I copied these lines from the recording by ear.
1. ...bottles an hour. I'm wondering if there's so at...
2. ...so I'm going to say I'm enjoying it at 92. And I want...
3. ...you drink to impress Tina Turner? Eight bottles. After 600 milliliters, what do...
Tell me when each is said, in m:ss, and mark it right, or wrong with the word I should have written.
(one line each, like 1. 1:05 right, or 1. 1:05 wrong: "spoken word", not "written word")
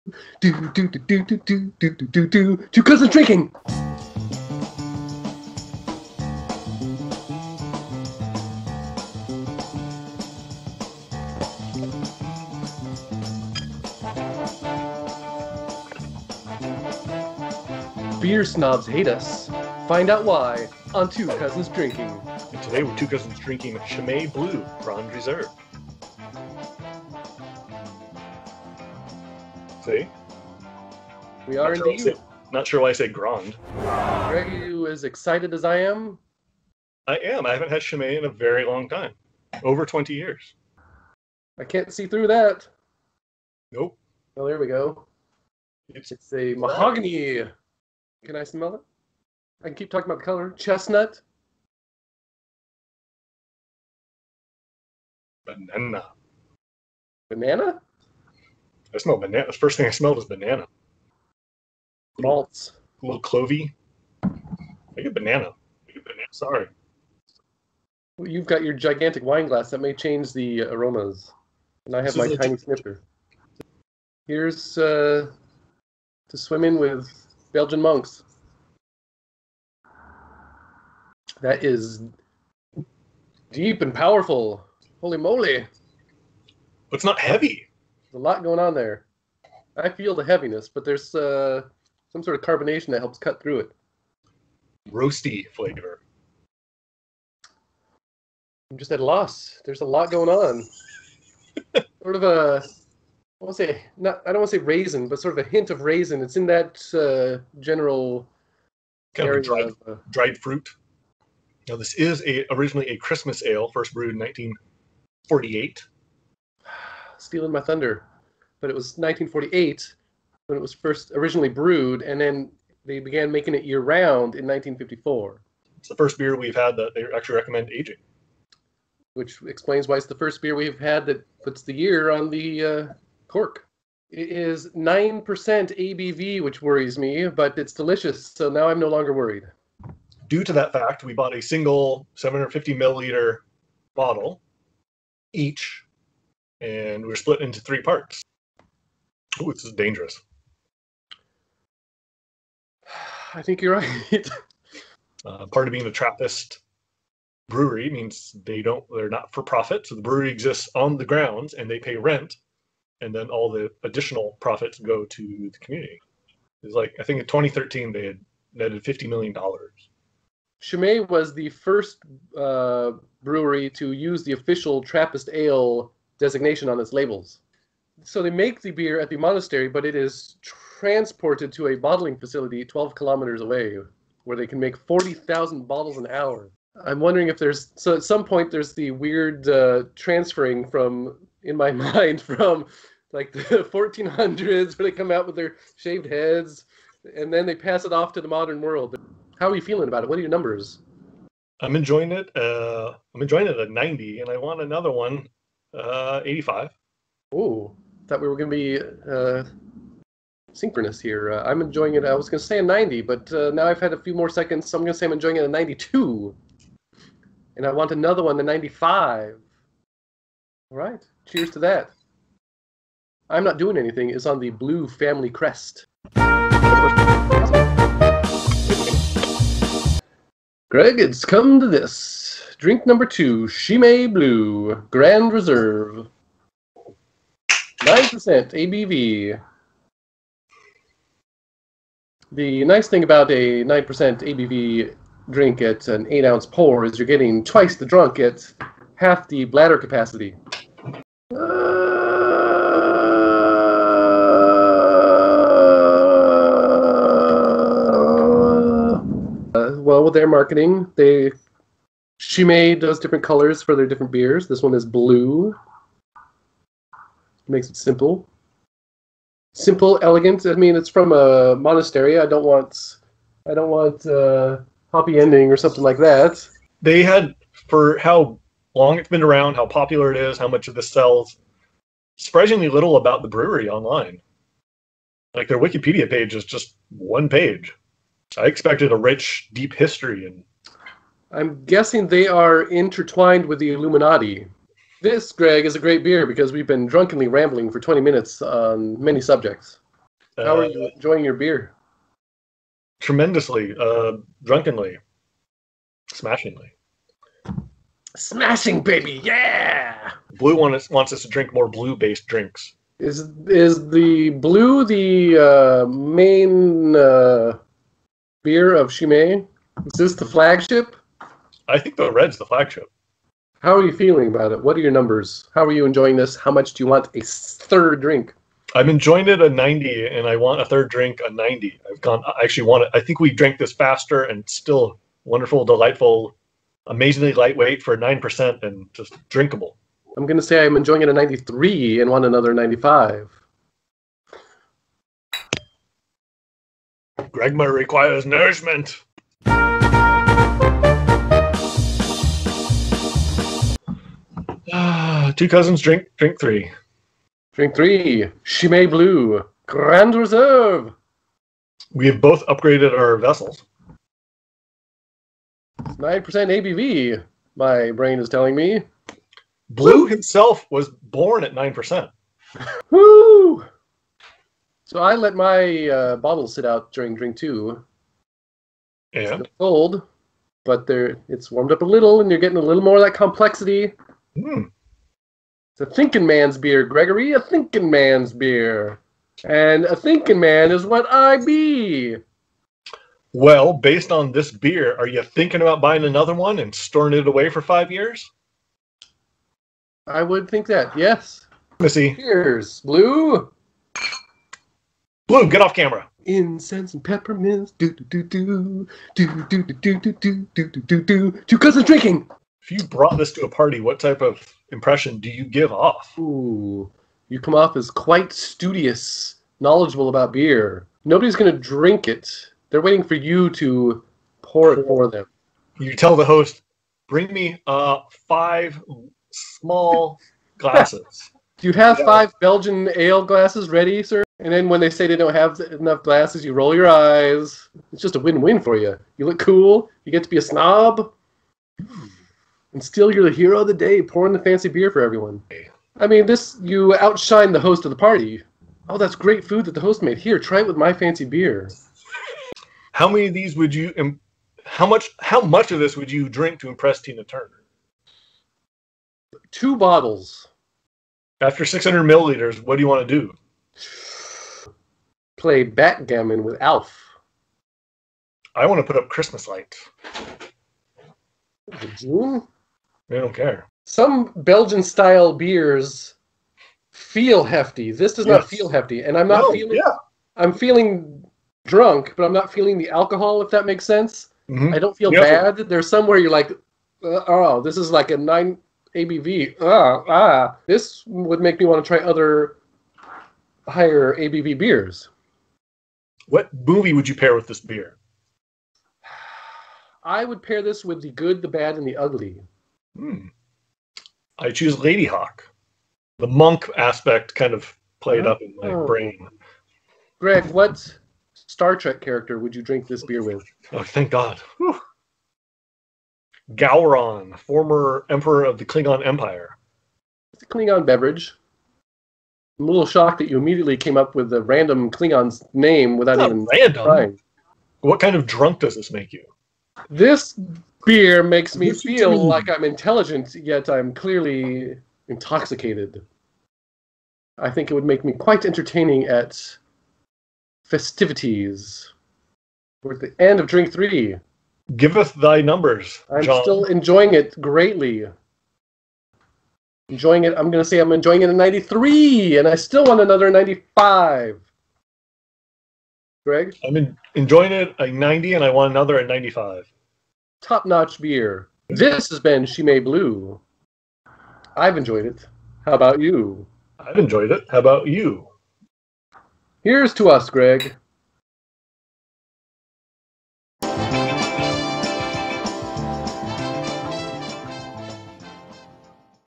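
1. 3:05 right
2. 3:34 right
3. 7:36 wrong: "Two", not "Eight".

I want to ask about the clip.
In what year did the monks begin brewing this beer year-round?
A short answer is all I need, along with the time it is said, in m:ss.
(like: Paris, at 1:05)
1954, at 2:04.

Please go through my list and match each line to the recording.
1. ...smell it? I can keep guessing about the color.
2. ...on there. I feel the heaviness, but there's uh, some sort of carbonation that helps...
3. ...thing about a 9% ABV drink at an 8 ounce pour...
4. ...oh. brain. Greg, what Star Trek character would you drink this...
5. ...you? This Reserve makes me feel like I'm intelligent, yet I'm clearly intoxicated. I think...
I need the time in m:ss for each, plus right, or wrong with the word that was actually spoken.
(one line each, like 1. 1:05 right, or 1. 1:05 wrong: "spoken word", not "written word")
1. 0:48 wrong: "talking", not "guessing"
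2. 1:28 right
3. 4:02 right
4. 8:28 right
5. 8:49 wrong: "Beer", not "Reserve".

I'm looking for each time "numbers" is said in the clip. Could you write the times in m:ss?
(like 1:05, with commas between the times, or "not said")
3:20, 3:52, 5:24, 9:05.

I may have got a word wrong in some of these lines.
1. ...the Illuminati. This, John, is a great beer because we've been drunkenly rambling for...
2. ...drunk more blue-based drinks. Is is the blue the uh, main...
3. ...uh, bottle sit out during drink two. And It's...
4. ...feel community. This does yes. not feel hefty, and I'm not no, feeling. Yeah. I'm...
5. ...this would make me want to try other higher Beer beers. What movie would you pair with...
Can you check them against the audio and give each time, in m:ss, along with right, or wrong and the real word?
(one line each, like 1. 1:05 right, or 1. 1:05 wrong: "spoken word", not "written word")
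1. 4:53 wrong: "Greg", not "John"
2. 5:11 wrong: "drink", not "drunk"
3. 6:15 right
4. 7:56 wrong: "hefty", not "community"
5. 8:10 wrong: "ABV", not "Beer".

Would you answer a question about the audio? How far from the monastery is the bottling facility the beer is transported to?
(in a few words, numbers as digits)
12 kilometers.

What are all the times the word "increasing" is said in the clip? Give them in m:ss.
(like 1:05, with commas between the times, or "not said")
not said.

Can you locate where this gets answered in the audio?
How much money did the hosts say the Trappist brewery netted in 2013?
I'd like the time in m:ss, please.
2:48.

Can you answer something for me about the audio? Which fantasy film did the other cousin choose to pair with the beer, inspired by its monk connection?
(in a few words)
Ladyhawke.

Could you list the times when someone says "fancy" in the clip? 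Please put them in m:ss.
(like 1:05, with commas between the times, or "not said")
7:24, 7:30.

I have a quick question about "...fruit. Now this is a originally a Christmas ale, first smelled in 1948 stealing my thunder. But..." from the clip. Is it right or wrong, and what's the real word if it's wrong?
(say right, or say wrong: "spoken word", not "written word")
wrong: "brewed", not "smelled".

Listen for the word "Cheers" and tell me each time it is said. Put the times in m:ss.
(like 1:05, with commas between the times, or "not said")
3:41, 6:42.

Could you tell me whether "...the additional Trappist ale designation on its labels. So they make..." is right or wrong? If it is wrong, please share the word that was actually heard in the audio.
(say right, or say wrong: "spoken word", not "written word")
wrong: "official", not "additional".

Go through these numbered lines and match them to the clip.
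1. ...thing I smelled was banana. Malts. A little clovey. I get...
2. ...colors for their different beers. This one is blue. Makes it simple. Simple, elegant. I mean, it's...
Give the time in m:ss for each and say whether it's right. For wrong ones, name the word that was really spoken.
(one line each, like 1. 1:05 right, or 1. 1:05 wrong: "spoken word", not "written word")
1. 0:59 right
2. 4:23 right.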